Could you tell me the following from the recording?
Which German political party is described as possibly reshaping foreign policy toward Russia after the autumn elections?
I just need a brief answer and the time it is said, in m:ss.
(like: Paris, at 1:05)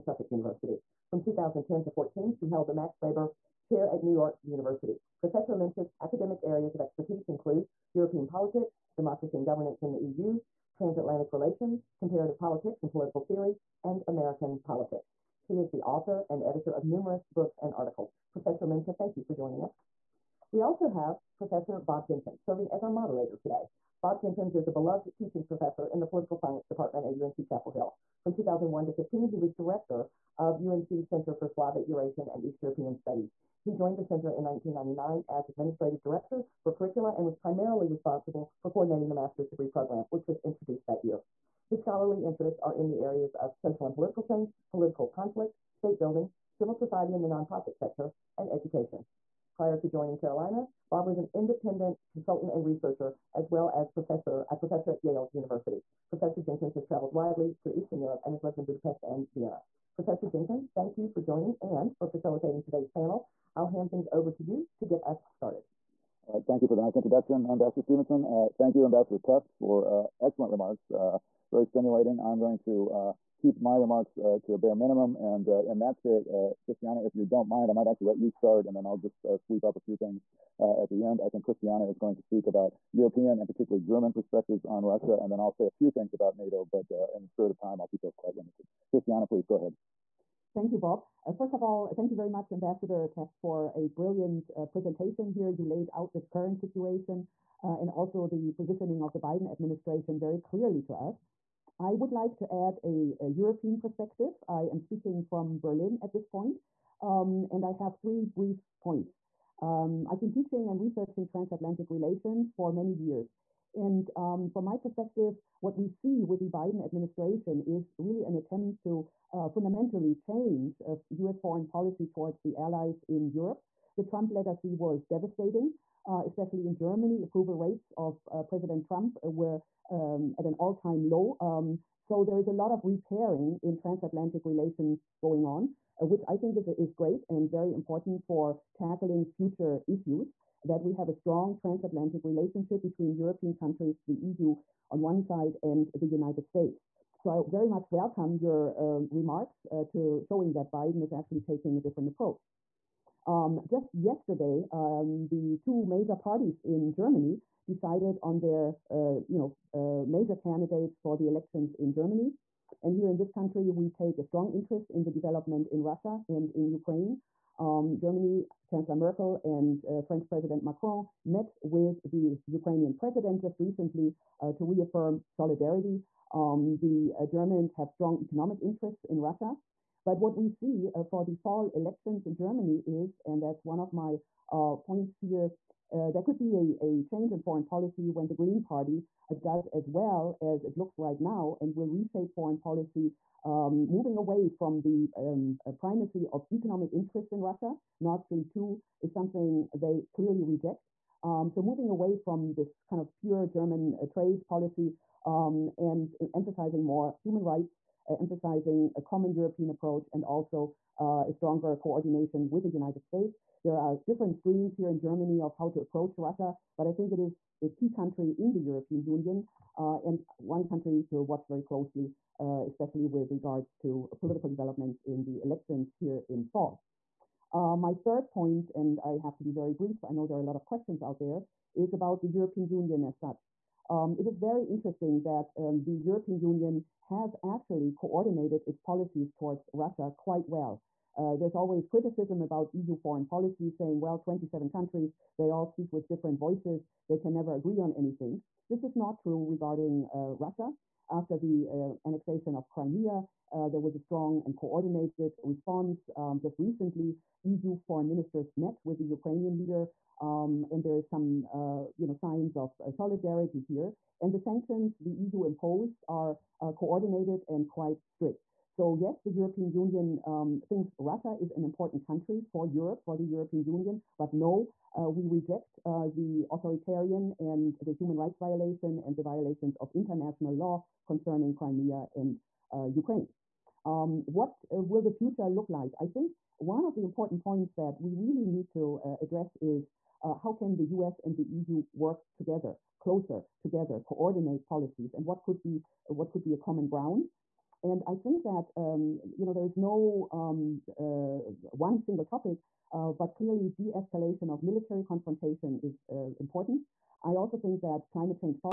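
Green Party, at 3:08.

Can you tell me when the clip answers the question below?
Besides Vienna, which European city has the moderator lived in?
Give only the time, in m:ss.
0:58.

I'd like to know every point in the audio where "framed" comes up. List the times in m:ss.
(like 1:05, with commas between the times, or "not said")
not said.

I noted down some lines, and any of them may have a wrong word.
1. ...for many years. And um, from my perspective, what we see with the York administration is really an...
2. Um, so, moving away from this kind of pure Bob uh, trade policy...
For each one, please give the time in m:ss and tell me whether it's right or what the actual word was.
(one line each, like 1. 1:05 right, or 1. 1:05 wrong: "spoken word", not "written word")
1. 1:52 wrong: "Biden", not "York"
2. 3:21 wrong: "German", not "Bob".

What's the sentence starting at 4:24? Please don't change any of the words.
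And the sanctions the EU imposed are uh, coordinated and quite strict.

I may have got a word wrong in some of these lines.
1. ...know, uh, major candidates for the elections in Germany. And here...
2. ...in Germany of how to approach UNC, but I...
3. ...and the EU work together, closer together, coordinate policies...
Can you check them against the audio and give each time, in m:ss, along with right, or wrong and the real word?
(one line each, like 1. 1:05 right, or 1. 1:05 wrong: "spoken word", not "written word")
1. 2:39 right
2. 3:34 wrong: "Russia", not "UNC"
3. 4:51 right.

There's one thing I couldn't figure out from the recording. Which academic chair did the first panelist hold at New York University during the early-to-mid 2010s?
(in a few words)
Max Weber Chair.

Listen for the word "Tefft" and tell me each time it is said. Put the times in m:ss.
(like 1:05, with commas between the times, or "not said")
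1:09, 1:33.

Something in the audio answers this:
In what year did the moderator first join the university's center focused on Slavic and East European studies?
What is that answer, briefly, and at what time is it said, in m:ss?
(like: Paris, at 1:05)
1999, at 0:34.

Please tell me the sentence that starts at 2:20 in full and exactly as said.
That we have a strong transatlantic relationship between European countries, the EU on one side, and the United States.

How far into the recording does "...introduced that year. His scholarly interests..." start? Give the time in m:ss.
0:40.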